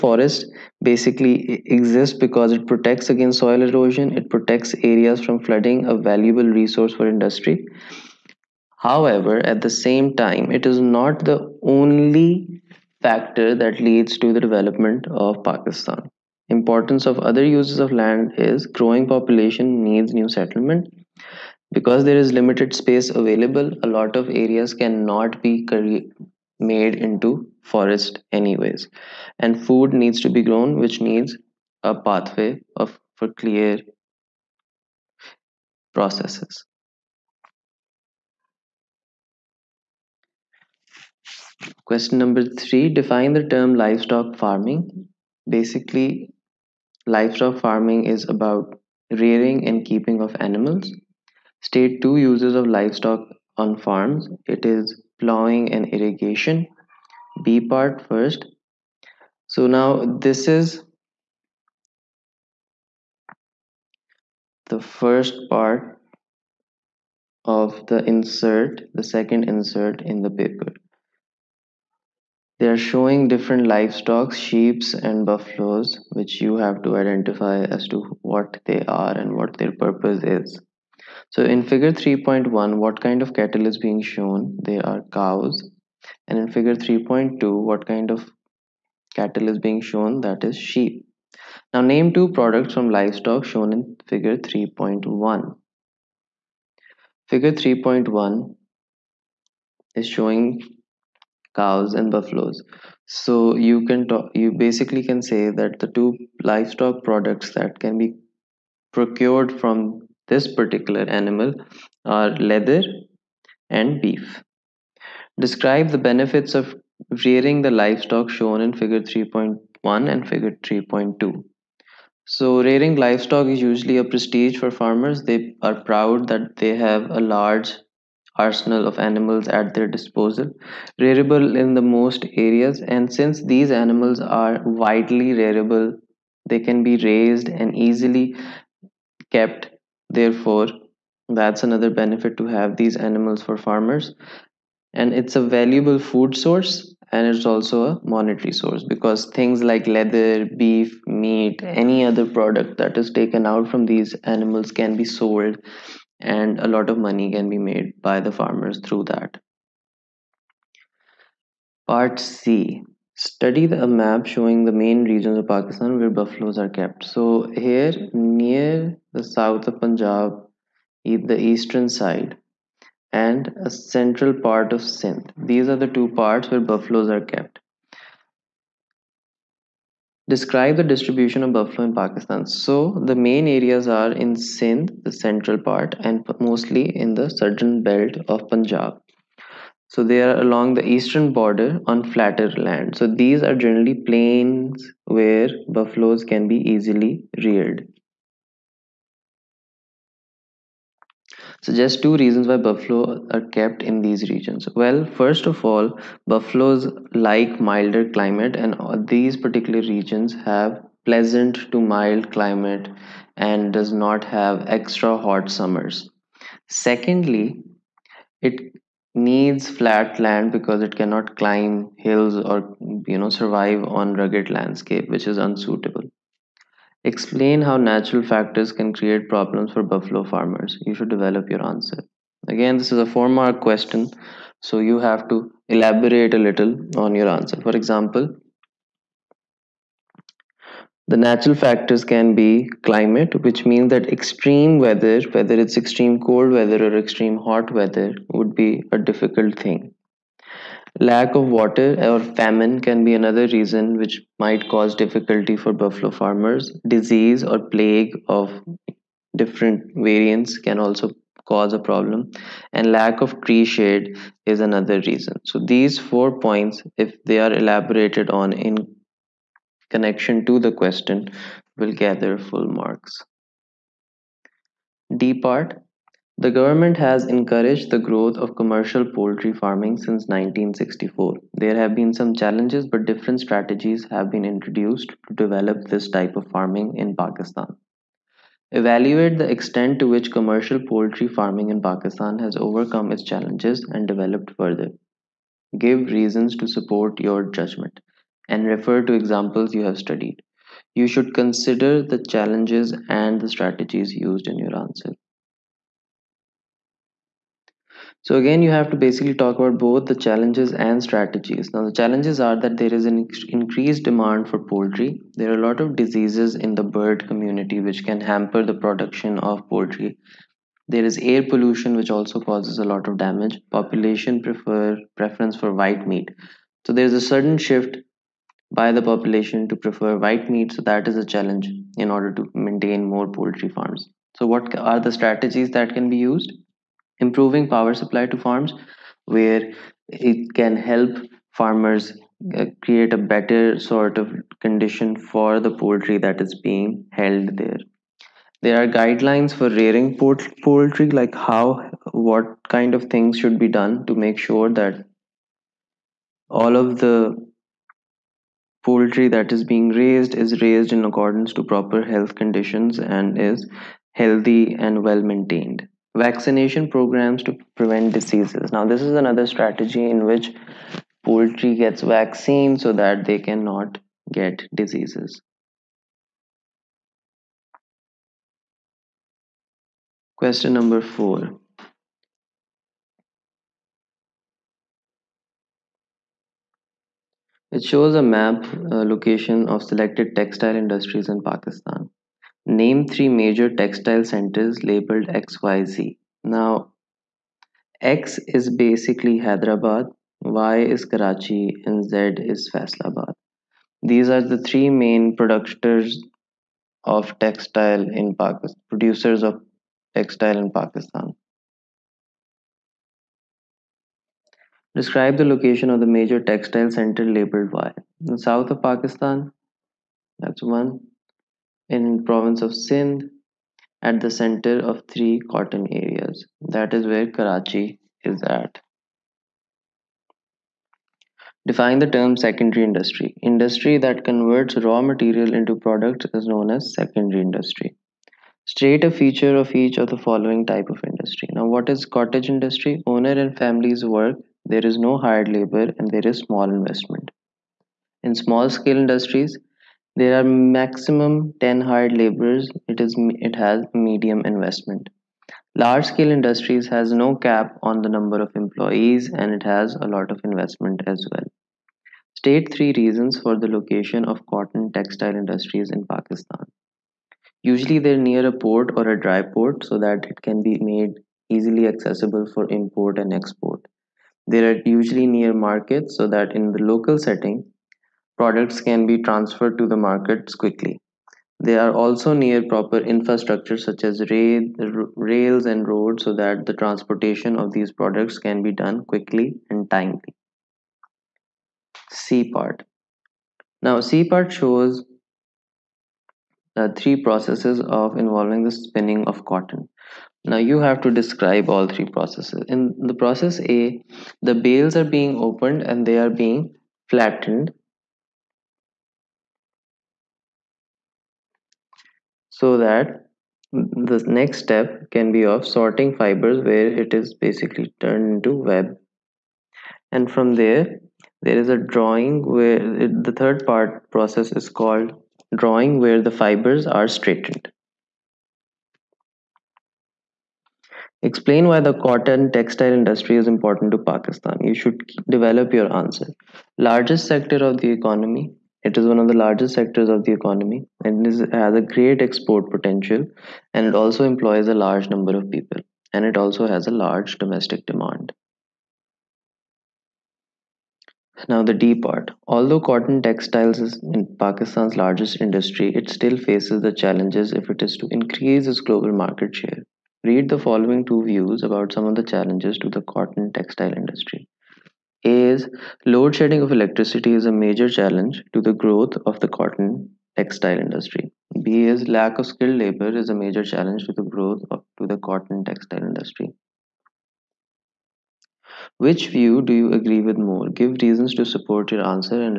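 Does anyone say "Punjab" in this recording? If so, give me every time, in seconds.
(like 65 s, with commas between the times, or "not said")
169 s, 188 s.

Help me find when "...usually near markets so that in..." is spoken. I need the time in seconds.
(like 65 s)
474 s.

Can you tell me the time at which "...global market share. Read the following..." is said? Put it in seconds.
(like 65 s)
558 s.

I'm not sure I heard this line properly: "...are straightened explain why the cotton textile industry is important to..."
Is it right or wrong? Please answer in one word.
right.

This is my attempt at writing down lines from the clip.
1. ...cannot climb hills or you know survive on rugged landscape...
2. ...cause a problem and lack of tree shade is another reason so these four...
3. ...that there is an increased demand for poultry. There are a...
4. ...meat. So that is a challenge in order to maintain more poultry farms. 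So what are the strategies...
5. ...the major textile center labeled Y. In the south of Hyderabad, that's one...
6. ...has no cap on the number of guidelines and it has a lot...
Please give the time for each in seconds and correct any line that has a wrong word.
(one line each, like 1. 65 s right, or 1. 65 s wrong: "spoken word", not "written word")
1. 220 s right
2. 261 s right
3. 312 s right
4. 330 s right
5. 415 s wrong: "Pakistan", not "Hyderabad"
6. 456 s wrong: "employees", not "guidelines".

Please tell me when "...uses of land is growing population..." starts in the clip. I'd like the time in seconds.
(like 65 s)
17 s.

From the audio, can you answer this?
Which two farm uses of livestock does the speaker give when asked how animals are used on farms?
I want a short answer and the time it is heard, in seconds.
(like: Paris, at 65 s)
Plowing and irrigation, at 55 s.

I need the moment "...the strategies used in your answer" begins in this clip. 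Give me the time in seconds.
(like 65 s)
303 s.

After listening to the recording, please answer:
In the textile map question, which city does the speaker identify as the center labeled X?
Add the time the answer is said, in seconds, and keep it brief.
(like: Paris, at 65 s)
Hyderabad, at 399 s.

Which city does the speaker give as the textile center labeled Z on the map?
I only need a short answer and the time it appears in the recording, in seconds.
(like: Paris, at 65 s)
Faisalabad, at 402 s.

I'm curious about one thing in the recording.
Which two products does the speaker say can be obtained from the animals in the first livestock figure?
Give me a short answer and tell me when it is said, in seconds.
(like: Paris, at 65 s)
Leather and beef, at 112 s.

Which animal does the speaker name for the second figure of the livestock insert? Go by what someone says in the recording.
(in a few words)
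Sheep.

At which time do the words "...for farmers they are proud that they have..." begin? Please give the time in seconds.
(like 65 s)
124 s.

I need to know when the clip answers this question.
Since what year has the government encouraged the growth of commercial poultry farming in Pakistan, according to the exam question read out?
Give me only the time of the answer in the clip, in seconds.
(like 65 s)
280 s.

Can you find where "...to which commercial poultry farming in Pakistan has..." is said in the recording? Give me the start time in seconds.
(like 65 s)
289 s.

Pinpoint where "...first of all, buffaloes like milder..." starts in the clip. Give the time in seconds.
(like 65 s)
205 s.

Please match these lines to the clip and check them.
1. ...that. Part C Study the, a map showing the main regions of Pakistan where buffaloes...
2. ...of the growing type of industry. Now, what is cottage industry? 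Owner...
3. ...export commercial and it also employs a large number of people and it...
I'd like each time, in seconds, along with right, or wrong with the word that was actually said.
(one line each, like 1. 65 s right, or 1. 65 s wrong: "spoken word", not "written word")
1. 159 s right
2. 439 s wrong: "following", not "growing"
3. 542 s wrong: "potential", not "commercial".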